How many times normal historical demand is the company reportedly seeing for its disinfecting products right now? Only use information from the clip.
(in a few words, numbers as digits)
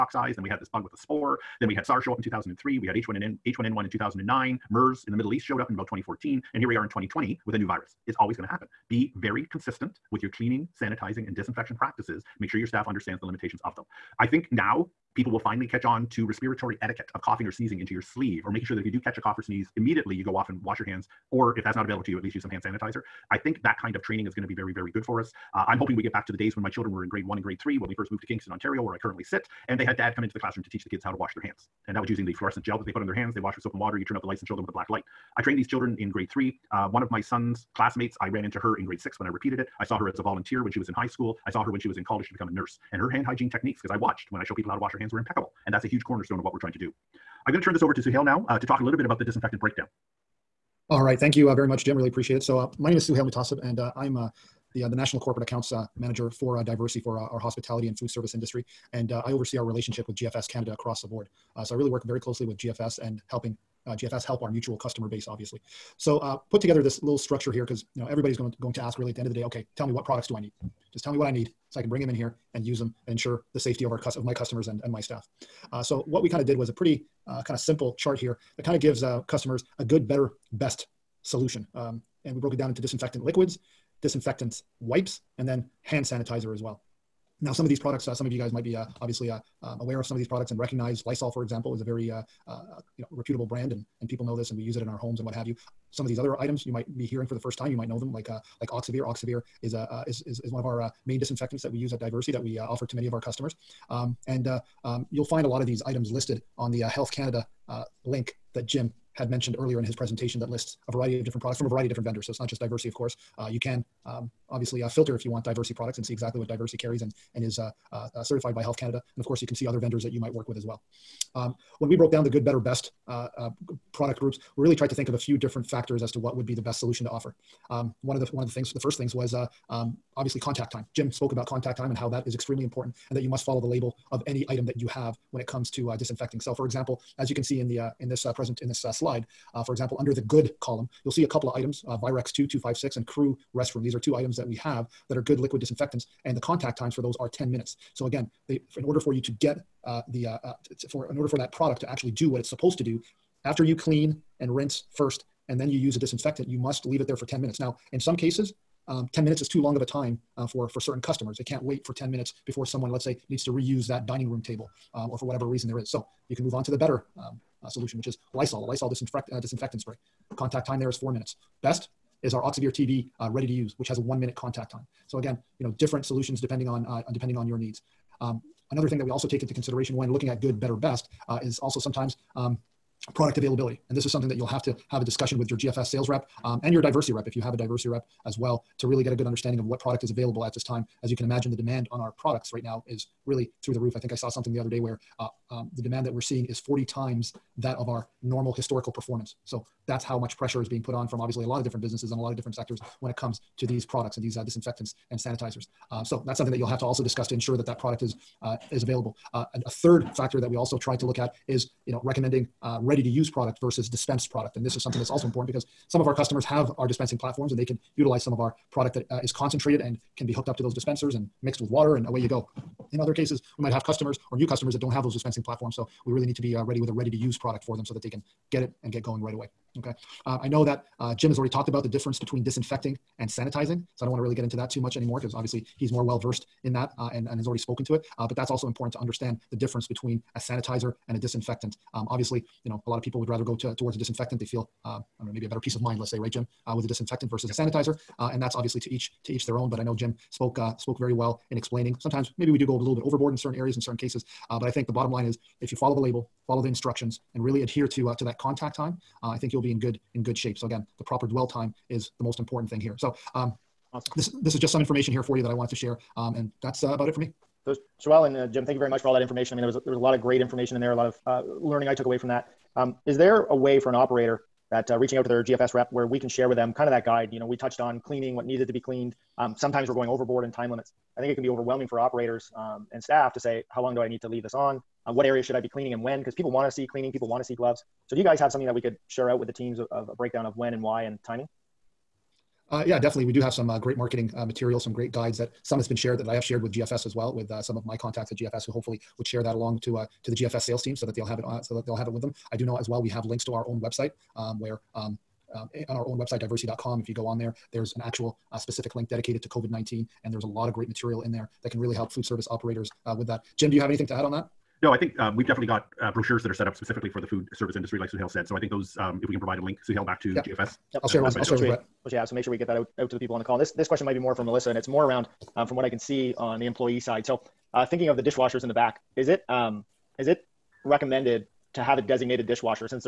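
40 times.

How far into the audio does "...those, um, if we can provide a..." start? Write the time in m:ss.
5:18.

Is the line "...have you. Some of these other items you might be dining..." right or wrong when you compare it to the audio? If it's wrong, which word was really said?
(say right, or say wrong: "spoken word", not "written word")
wrong: "hearing", not "dining".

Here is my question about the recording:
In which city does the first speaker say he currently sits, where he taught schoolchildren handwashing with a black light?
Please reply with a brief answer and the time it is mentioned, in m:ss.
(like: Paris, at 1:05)
Kingston, Ontario, at 0:28.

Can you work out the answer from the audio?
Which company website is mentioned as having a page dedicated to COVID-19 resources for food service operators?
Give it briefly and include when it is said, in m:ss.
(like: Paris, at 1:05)
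diversey.com, at 5:06.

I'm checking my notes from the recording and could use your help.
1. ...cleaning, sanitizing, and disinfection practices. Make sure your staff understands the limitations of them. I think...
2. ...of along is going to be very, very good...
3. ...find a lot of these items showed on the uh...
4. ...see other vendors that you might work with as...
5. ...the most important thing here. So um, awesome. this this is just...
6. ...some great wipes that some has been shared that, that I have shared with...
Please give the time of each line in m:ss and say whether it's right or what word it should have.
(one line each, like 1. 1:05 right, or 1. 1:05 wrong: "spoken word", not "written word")
1. 0:10 right
2. 0:23 wrong: "training", not "along"
3. 1:45 wrong: "listed", not "showed"
4. 1:59 right
5. 4:22 right
6. 4:54 wrong: "guides", not "wipes".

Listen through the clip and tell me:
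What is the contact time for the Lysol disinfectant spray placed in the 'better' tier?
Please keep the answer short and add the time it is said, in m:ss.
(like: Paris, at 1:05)
4 minutes, at 2:50.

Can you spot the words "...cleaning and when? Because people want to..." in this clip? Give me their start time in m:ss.
4:45.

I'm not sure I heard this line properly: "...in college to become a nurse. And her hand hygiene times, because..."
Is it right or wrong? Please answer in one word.
wrong.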